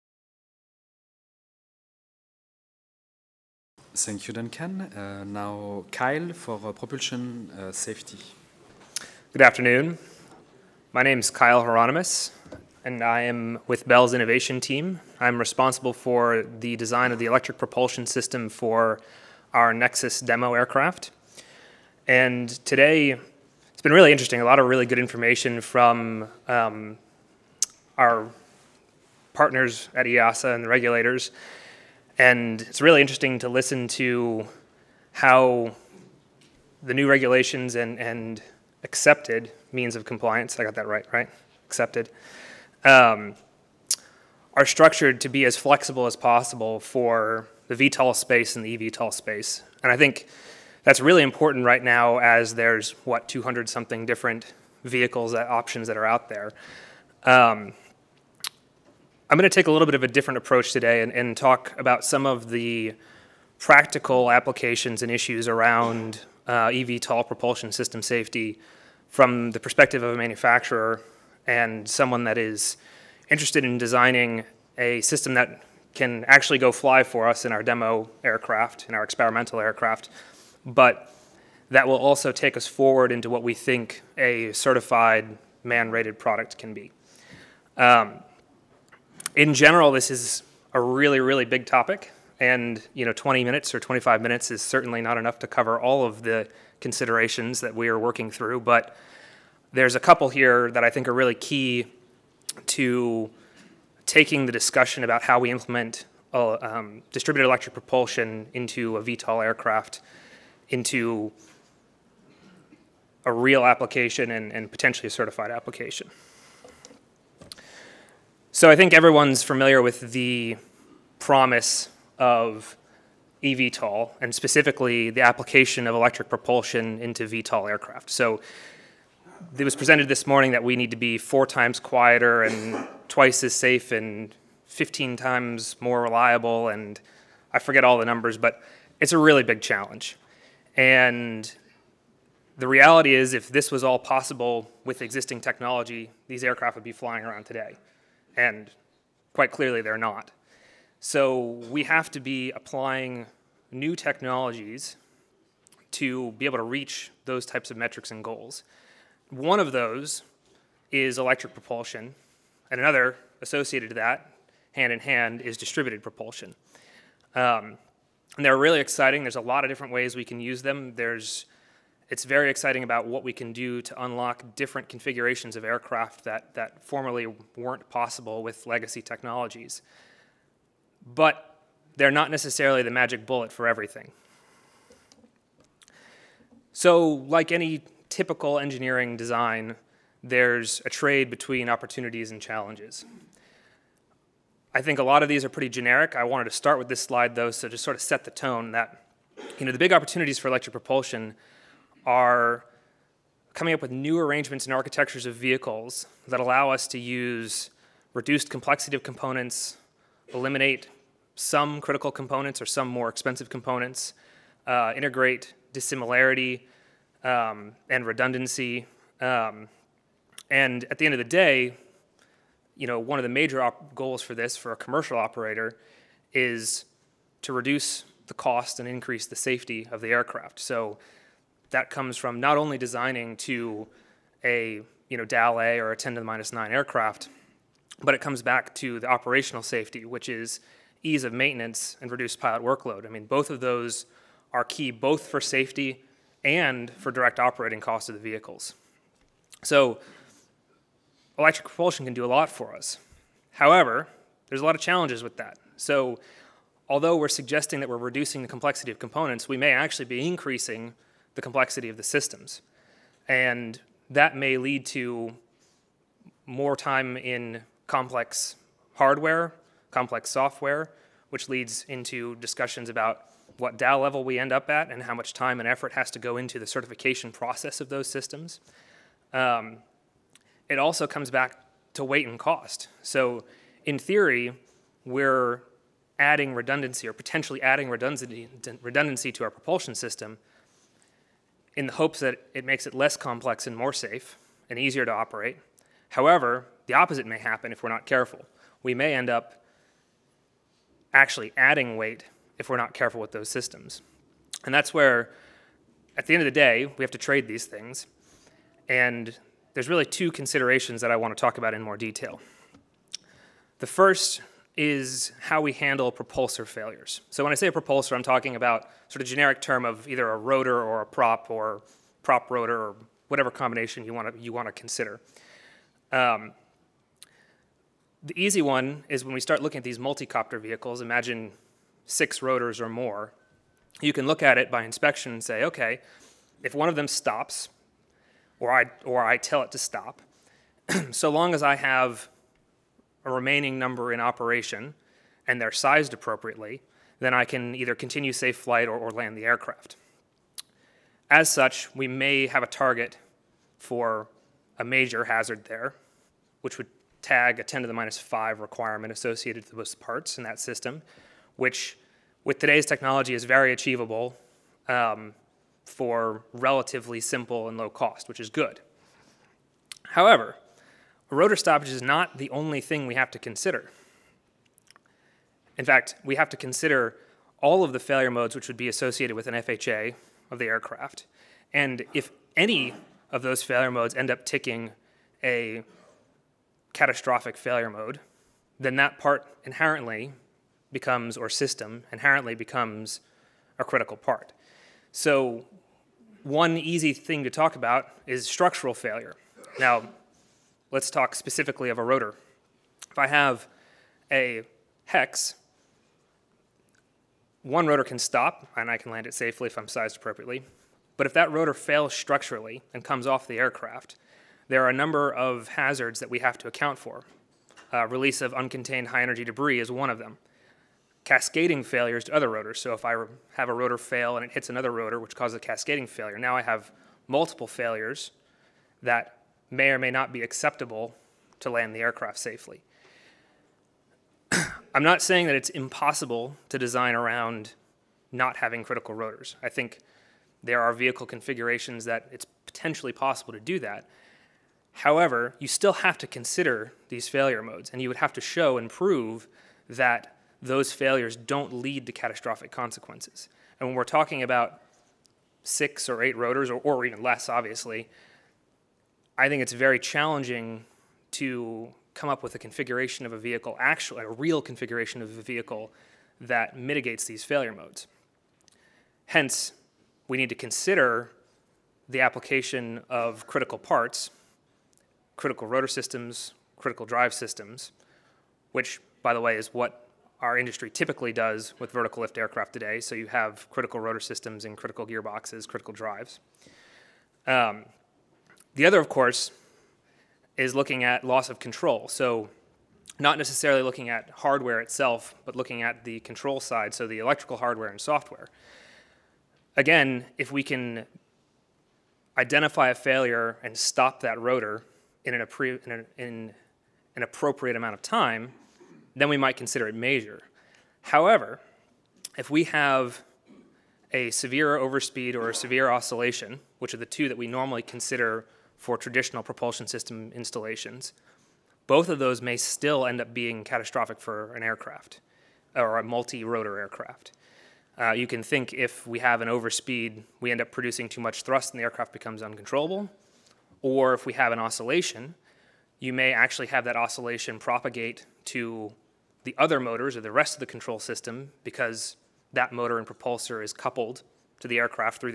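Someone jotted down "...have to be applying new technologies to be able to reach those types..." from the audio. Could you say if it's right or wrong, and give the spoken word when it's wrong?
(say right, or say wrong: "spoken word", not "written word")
right.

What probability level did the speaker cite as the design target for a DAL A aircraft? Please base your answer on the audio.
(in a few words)
10 to the minus 9.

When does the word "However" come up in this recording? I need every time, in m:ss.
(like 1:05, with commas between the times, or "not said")
4:13, 4:56, 6:10, 7:24, 8:31.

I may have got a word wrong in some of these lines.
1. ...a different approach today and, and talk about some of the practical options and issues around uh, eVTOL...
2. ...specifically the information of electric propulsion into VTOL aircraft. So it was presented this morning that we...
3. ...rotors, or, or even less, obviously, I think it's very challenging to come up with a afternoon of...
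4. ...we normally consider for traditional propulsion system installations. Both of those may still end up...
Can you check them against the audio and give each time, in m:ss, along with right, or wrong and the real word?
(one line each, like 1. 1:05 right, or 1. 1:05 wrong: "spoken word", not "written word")
1. 1:00 wrong: "applications", not "options"
2. 2:04 wrong: "application", not "information"
3. 7:36 wrong: "configuration", not "afternoon"
4. 8:37 right.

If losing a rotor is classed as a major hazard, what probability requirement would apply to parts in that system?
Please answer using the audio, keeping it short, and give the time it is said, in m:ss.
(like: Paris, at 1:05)
10 to the minus 5, at 5:57.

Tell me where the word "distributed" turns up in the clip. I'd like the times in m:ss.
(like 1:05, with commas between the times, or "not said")
1:47, 2:45.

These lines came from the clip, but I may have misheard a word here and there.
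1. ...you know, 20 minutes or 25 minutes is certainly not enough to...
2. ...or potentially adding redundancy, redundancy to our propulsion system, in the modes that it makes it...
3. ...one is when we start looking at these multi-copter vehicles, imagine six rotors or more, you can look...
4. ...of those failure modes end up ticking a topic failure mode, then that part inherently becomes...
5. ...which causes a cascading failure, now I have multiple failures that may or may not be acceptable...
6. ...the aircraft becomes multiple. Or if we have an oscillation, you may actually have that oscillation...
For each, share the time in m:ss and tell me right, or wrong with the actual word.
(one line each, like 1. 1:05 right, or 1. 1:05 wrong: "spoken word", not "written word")
1. 1:32 right
2. 4:47 wrong: "hopes", not "modes"
3. 5:28 right
4. 6:23 wrong: "catastrophic", not "topic"
5. 7:05 right
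6. 8:51 wrong: "uncontrollable", not "multiple".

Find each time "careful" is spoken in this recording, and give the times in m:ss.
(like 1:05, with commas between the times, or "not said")
4:58, 5:02.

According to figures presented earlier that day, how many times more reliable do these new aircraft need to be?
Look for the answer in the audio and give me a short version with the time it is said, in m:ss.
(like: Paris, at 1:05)
15, at 2:14.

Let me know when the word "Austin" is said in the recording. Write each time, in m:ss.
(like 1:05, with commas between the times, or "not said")
not said.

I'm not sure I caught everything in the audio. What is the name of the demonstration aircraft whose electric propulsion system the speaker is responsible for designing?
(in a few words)
Nexus.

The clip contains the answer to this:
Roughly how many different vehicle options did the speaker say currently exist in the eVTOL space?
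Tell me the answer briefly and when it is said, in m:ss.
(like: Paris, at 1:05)
200 something, at 0:53.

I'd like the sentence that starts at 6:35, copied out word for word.
So, one easy thing to talk about is structural failure.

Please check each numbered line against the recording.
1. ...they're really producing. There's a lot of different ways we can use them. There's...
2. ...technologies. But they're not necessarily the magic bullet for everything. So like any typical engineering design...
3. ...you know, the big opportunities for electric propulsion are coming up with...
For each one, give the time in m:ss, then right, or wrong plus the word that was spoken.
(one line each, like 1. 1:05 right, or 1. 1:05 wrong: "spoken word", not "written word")
1. 2:48 wrong: "exciting", not "producing"
2. 2:59 right
3. 3:19 right.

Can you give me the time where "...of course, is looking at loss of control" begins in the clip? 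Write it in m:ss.
8:08.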